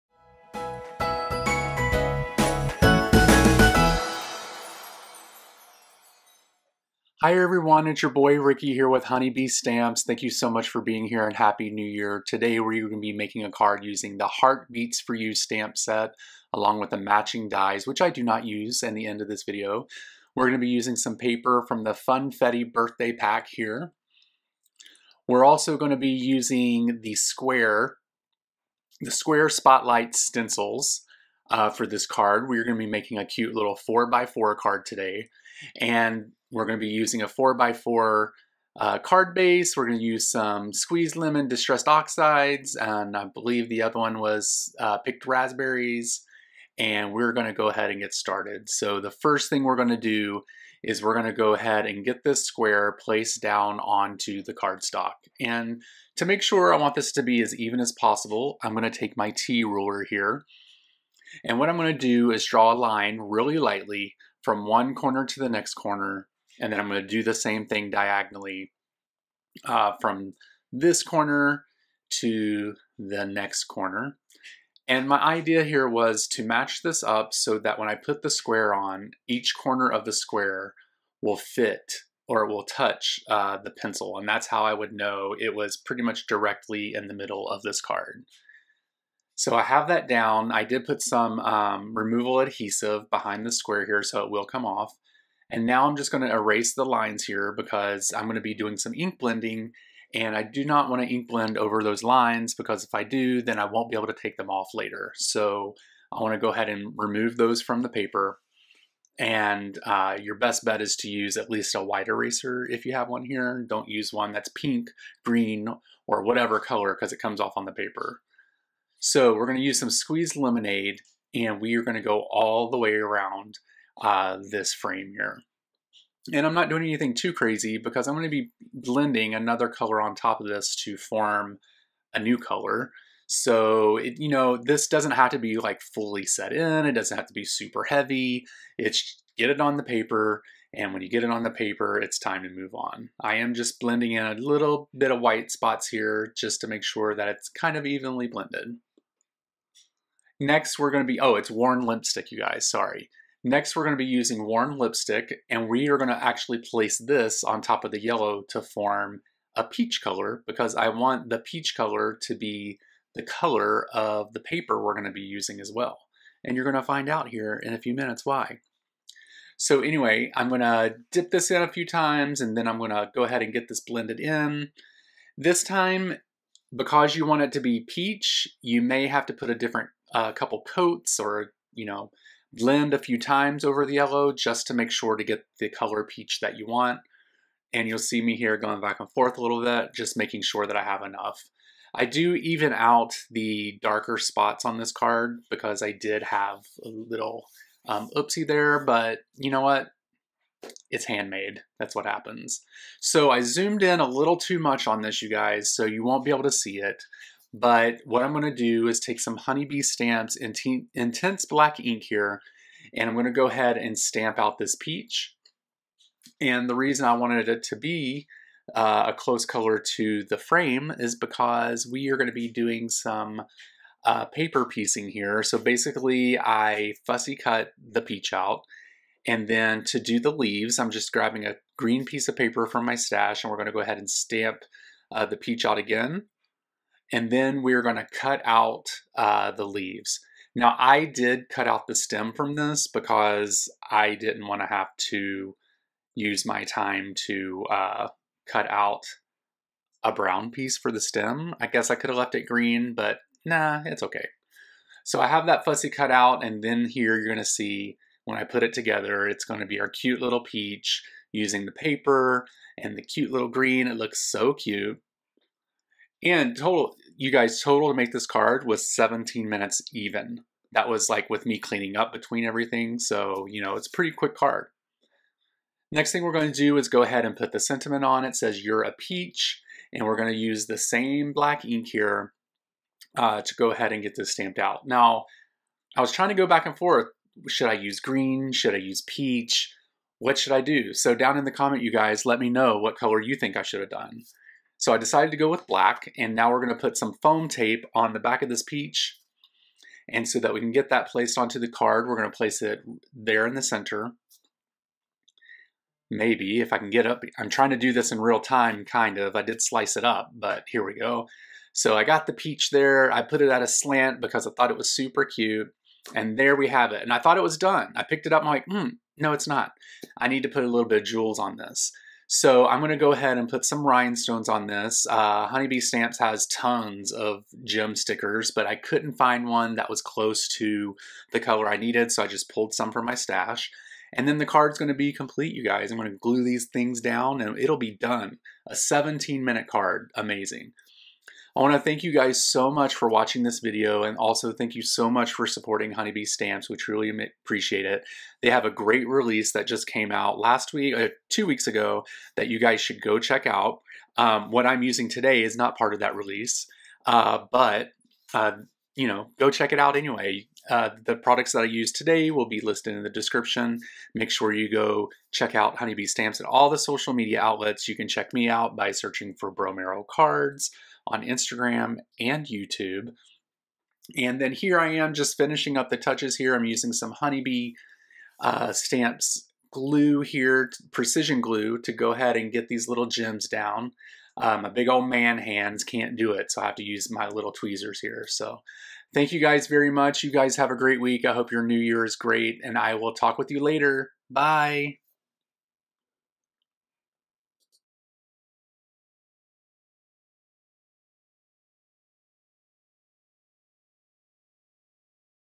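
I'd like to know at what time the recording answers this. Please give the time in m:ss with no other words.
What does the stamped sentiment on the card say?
4:38.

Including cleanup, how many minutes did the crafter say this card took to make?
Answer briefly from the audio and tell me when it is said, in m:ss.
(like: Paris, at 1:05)
17 minutes, at 4:28.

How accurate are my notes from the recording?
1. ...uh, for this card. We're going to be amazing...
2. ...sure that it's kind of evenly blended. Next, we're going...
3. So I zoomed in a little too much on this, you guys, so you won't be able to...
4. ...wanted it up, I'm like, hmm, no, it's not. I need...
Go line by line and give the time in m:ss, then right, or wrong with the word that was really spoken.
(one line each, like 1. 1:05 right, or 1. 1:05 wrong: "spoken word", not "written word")
1. 0:31 wrong: "making", not "amazing"
2. 2:26 right
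3. 3:22 right
4. 5:18 wrong: "picked", not "wanted".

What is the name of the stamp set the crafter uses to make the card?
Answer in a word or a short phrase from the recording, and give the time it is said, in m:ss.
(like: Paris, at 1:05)
Heart Beets for You, at 0:14.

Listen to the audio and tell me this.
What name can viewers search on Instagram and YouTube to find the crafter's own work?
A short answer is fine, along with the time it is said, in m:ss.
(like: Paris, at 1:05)
Bromero Cards, at 6:09.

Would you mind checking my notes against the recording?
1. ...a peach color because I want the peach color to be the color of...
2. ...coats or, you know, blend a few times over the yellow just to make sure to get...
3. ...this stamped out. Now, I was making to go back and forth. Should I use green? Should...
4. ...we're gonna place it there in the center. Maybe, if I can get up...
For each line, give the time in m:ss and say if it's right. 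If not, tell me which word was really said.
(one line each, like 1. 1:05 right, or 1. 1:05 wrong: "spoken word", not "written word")
1. 2:39 right
2. 3:00 right
3. 4:44 wrong: "trying", not "making"
4. 5:02 right.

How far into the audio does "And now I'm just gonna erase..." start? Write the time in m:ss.
1:35.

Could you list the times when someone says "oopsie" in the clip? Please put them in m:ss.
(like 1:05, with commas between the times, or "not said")
3:18.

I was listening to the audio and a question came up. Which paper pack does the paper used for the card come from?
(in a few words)
Funfetti birthday pack.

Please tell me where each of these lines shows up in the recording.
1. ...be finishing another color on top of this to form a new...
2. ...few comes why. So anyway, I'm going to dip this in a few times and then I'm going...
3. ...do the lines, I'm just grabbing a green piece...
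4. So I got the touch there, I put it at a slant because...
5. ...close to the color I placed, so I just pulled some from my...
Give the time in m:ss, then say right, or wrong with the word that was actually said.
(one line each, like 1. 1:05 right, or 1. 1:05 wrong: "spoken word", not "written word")
1. 2:08 wrong: "blending", not "finishing"
2. 2:47 wrong: "minutes", not "comes"
3. 3:49 wrong: "leaves", not "lines"
4. 5:11 wrong: "peach", not "touch"
5. 5:30 wrong: "needed", not "placed".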